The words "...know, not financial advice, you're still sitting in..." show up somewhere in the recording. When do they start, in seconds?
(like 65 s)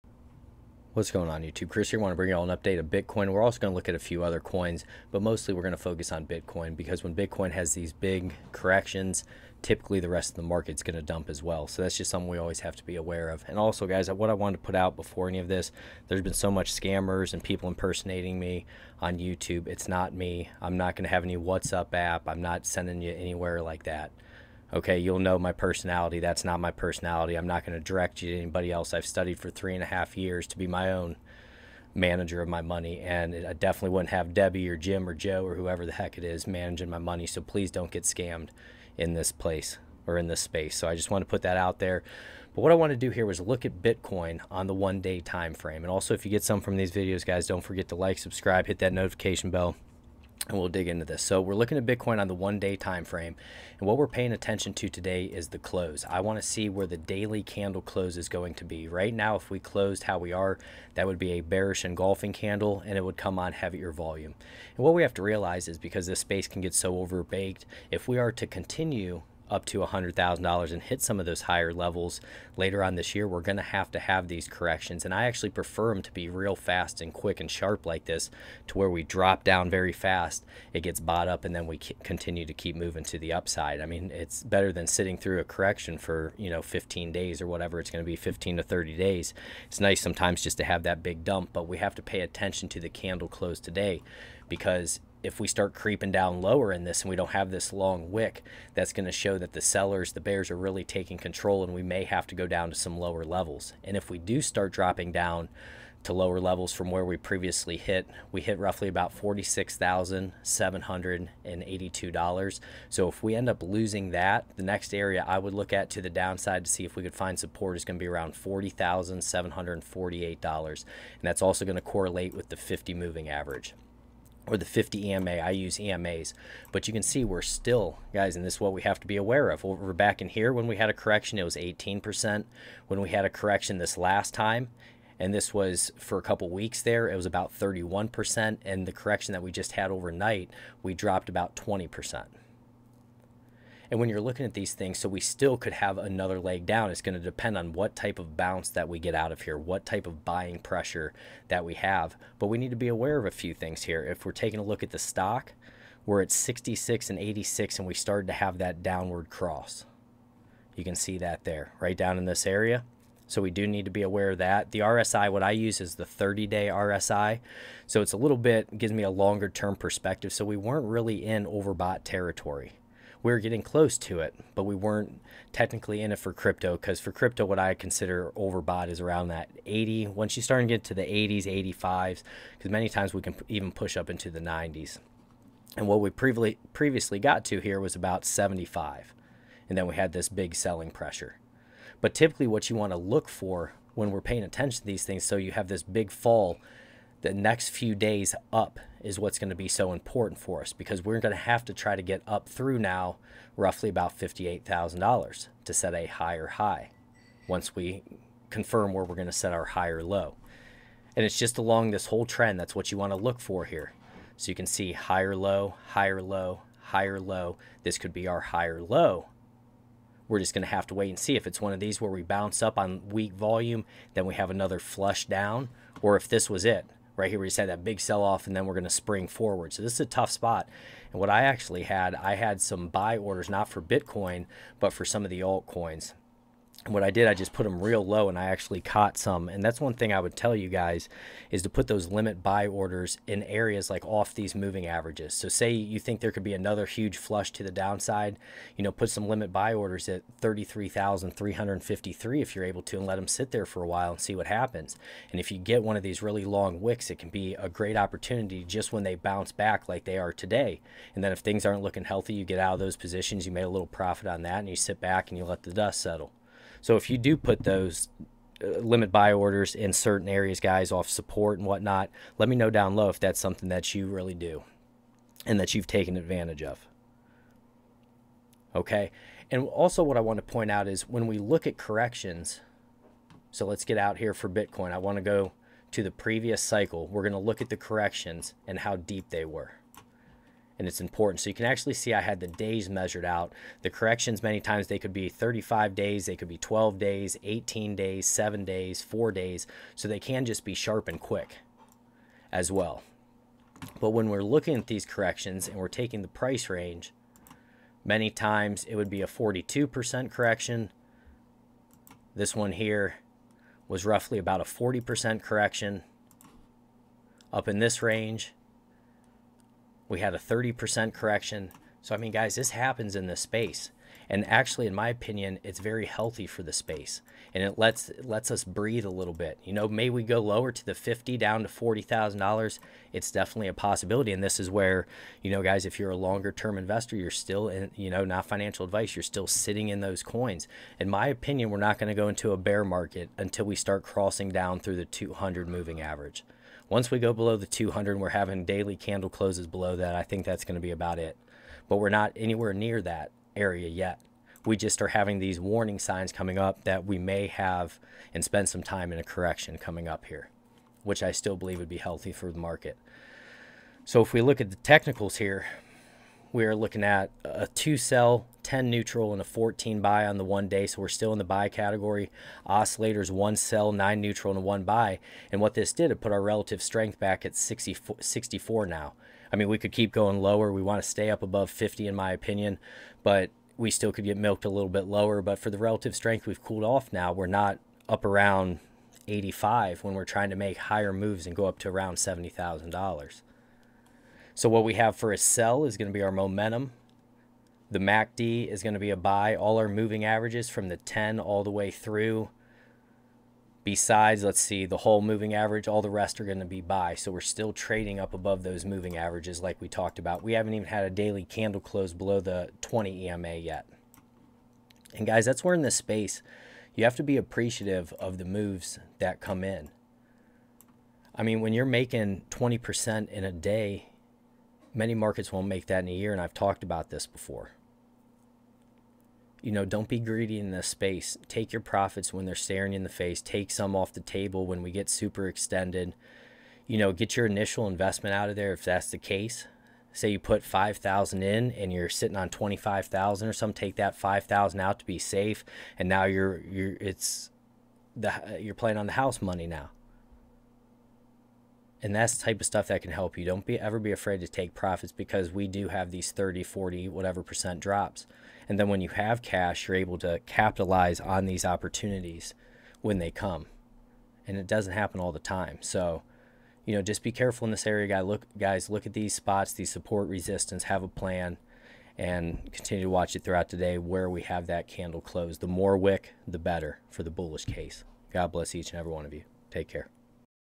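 338 s.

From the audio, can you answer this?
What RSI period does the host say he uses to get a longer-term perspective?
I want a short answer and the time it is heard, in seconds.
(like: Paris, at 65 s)
30 day, at 166 s.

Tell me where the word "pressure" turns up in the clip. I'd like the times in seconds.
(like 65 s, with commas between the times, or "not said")
150 s, 190 s.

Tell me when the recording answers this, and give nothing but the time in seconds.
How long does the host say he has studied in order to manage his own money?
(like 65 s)
29 s.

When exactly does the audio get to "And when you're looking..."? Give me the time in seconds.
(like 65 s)
143 s.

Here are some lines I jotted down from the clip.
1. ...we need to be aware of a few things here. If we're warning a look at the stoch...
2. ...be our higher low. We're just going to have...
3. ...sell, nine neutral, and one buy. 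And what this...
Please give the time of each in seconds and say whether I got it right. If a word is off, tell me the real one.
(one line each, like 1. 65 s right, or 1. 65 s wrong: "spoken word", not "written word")
1. 152 s wrong: "taking", not "warning"
2. 218 s right
3. 373 s right.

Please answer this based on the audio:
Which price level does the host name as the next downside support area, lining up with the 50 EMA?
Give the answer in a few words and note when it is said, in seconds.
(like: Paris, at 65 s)
$40,748, at 118 s.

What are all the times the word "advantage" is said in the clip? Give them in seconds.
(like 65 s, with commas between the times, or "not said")
276 s.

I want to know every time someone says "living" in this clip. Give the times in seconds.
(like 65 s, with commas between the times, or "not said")
not said.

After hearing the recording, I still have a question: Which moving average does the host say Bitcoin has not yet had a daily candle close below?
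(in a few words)
20 EMA.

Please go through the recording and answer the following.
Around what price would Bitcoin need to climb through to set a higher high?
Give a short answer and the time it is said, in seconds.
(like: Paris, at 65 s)
$58,000, at 204 s.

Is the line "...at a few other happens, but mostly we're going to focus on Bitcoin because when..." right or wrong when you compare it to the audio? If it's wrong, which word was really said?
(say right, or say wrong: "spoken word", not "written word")
wrong: "coins", not "happens".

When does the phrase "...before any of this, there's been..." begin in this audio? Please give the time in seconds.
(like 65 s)
14 s.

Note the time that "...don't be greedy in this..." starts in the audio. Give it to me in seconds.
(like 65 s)
429 s.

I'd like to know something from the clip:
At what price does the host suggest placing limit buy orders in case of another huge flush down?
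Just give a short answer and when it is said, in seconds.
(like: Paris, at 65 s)
33,353, at 250 s.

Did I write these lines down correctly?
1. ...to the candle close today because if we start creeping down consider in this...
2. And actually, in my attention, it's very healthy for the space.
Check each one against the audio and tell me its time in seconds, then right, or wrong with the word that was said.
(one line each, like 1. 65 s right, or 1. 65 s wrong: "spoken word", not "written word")
1. 92 s wrong: "lower", not "consider"
2. 324 s wrong: "opinion", not "attention".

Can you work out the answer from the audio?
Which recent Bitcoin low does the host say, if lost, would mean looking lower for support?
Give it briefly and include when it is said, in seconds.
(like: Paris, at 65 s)
$46,782, at 109 s.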